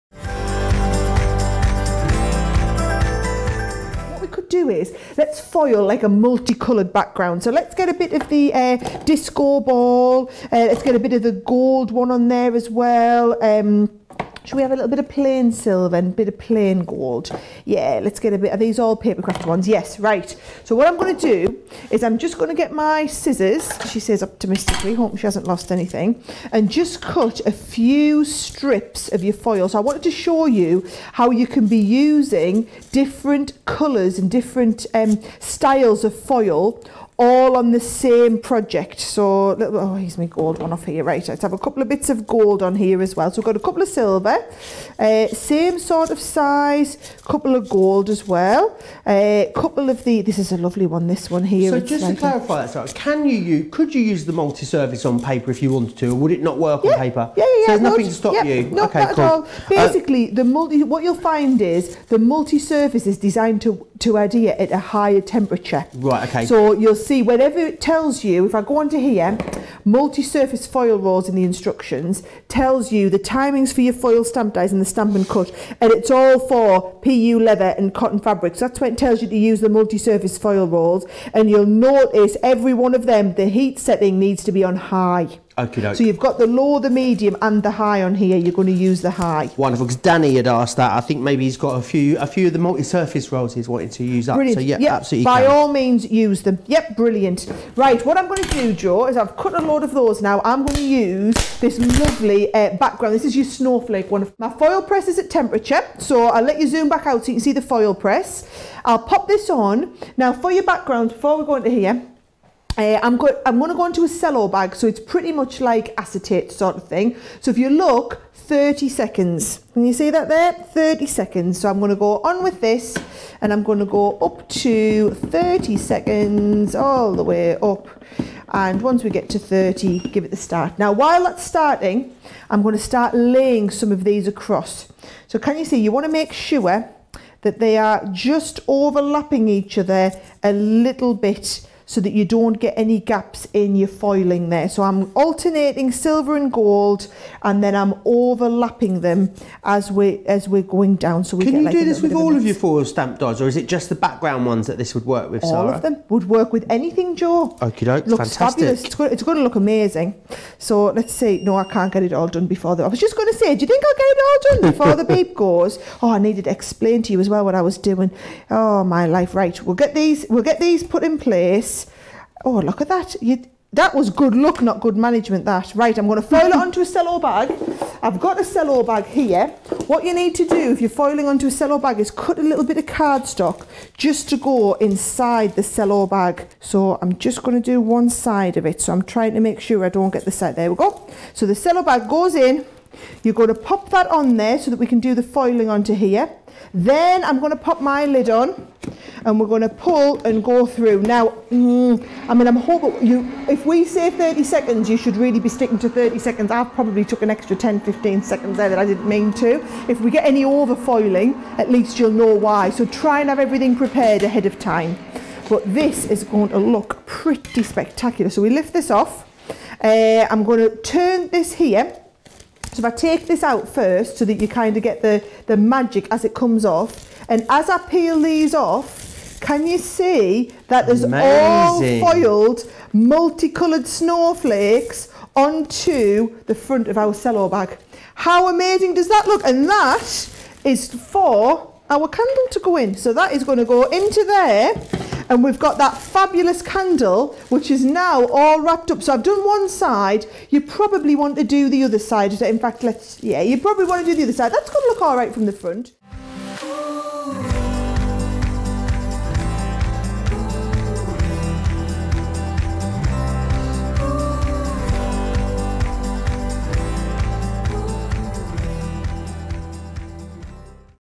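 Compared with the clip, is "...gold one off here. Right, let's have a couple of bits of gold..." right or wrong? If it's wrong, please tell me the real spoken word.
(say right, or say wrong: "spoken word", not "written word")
right.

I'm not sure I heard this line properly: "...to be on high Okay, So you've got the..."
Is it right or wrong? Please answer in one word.
right.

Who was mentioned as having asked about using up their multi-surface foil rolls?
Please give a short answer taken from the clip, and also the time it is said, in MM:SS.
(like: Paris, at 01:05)
Danny, at 01:30.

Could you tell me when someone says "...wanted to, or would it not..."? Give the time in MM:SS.
00:55.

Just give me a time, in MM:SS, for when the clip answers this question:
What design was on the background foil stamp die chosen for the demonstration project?
01:43.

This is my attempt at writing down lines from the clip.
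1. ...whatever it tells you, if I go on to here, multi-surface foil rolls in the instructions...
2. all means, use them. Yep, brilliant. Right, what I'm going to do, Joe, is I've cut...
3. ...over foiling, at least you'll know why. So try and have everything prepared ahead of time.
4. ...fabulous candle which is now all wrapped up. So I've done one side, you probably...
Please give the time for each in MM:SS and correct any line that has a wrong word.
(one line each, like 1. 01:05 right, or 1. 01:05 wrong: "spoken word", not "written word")
1. 01:07 right
2. 01:35 right
3. 03:30 right
4. 04:05 right.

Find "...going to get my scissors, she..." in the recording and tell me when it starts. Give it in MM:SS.
00:22.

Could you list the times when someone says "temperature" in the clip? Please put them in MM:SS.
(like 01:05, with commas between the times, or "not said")
01:05, 01:45.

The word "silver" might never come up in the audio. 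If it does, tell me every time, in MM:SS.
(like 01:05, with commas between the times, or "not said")
00:15, 00:43, 02:25.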